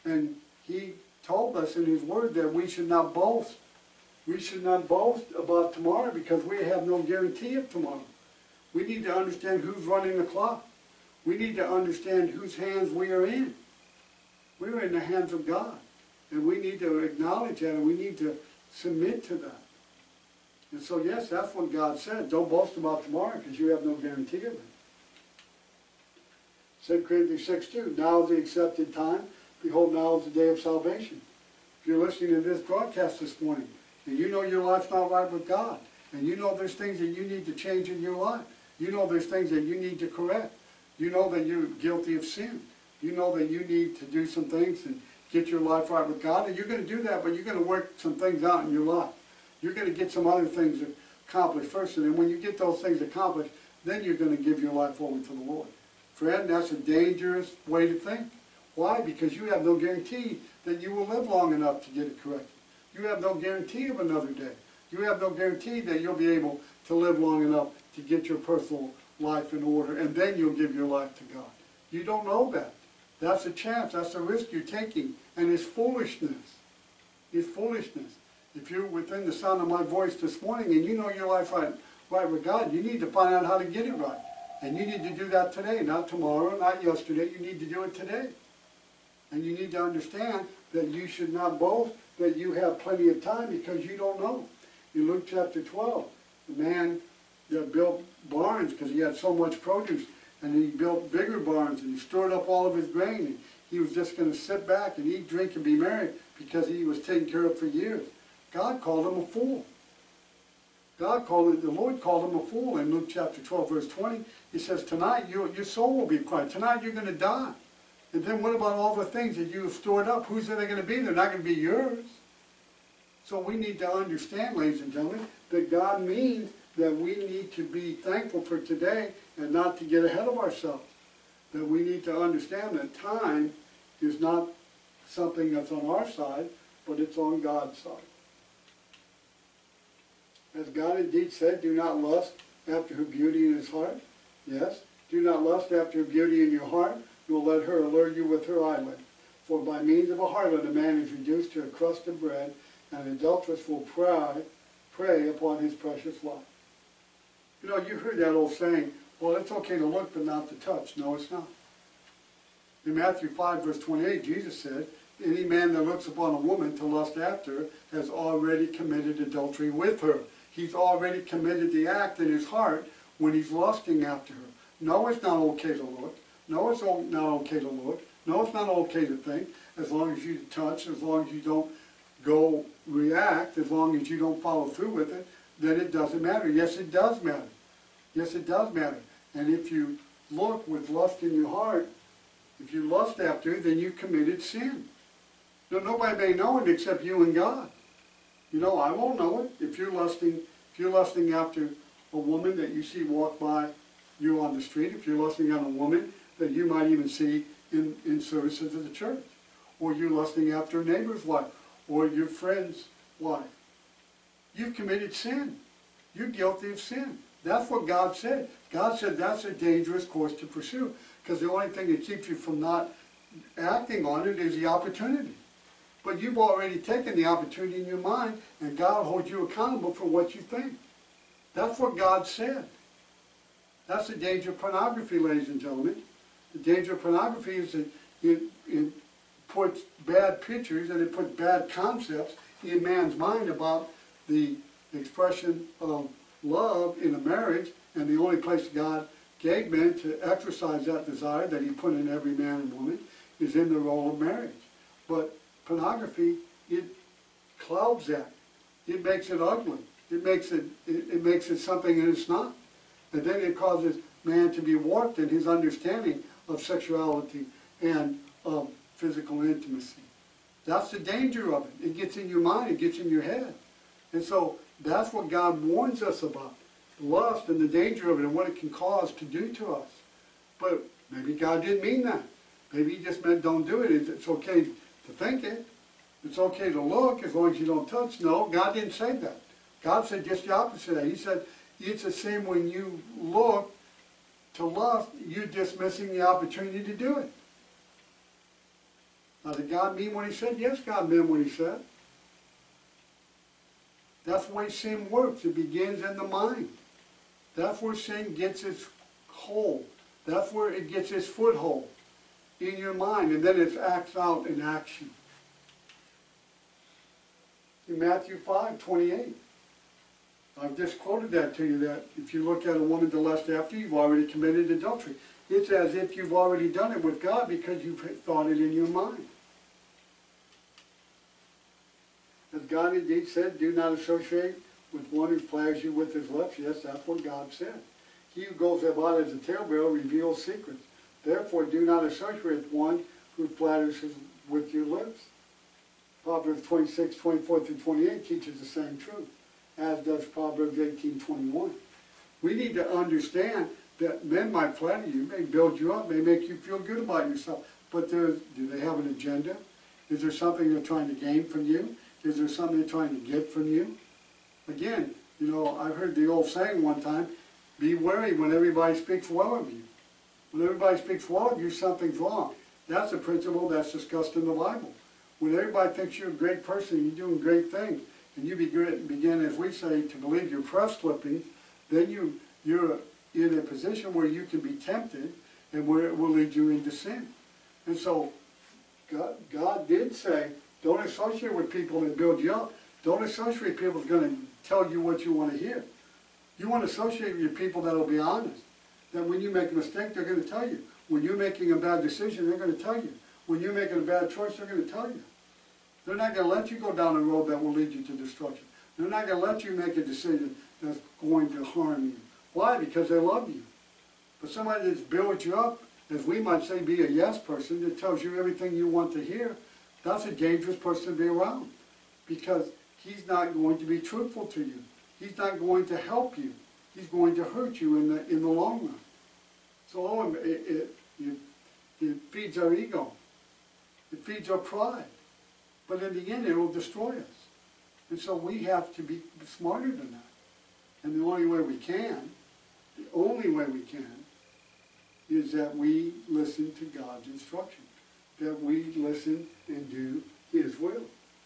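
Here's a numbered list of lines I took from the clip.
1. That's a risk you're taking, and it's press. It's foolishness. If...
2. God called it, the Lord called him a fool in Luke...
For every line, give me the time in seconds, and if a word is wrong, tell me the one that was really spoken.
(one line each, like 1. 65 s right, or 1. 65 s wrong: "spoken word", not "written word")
1. 73 s wrong: "foolishness", not "press"
2. 110 s right.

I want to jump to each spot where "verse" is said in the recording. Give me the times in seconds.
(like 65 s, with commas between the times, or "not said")
113 s, 163 s.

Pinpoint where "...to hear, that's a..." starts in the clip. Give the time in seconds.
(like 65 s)
419 s.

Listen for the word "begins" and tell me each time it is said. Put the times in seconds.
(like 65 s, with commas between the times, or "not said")
305 s, 378 s.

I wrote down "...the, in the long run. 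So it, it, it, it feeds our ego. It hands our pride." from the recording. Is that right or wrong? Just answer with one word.
wrong.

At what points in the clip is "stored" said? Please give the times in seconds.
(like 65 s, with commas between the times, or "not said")
101 s, 119 s.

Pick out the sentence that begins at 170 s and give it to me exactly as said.
He's already committed the act in his heart when he's lusting after her.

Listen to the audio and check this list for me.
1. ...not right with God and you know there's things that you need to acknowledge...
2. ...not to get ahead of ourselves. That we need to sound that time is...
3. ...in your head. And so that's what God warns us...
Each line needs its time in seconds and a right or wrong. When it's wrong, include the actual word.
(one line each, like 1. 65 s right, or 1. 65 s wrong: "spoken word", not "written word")
1. 34 s wrong: "change", not "acknowledge"
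2. 129 s wrong: "understand", not "sound"
3. 272 s right.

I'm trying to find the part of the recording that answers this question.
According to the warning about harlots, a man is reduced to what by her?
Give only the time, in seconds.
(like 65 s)
151 s.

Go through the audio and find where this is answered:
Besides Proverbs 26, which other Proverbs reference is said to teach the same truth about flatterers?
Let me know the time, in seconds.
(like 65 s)
350 s.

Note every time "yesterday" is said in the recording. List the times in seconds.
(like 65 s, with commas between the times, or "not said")
86 s.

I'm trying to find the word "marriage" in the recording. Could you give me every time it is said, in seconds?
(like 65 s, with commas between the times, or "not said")
247 s, 254 s.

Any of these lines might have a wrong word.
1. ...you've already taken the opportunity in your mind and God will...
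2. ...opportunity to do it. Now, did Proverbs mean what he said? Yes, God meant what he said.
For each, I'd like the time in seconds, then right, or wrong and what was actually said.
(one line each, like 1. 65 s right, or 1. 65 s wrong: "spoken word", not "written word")
1. 226 s right
2. 296 s wrong: "God", not "Proverbs".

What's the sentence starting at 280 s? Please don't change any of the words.
But maybe God didn't mean that.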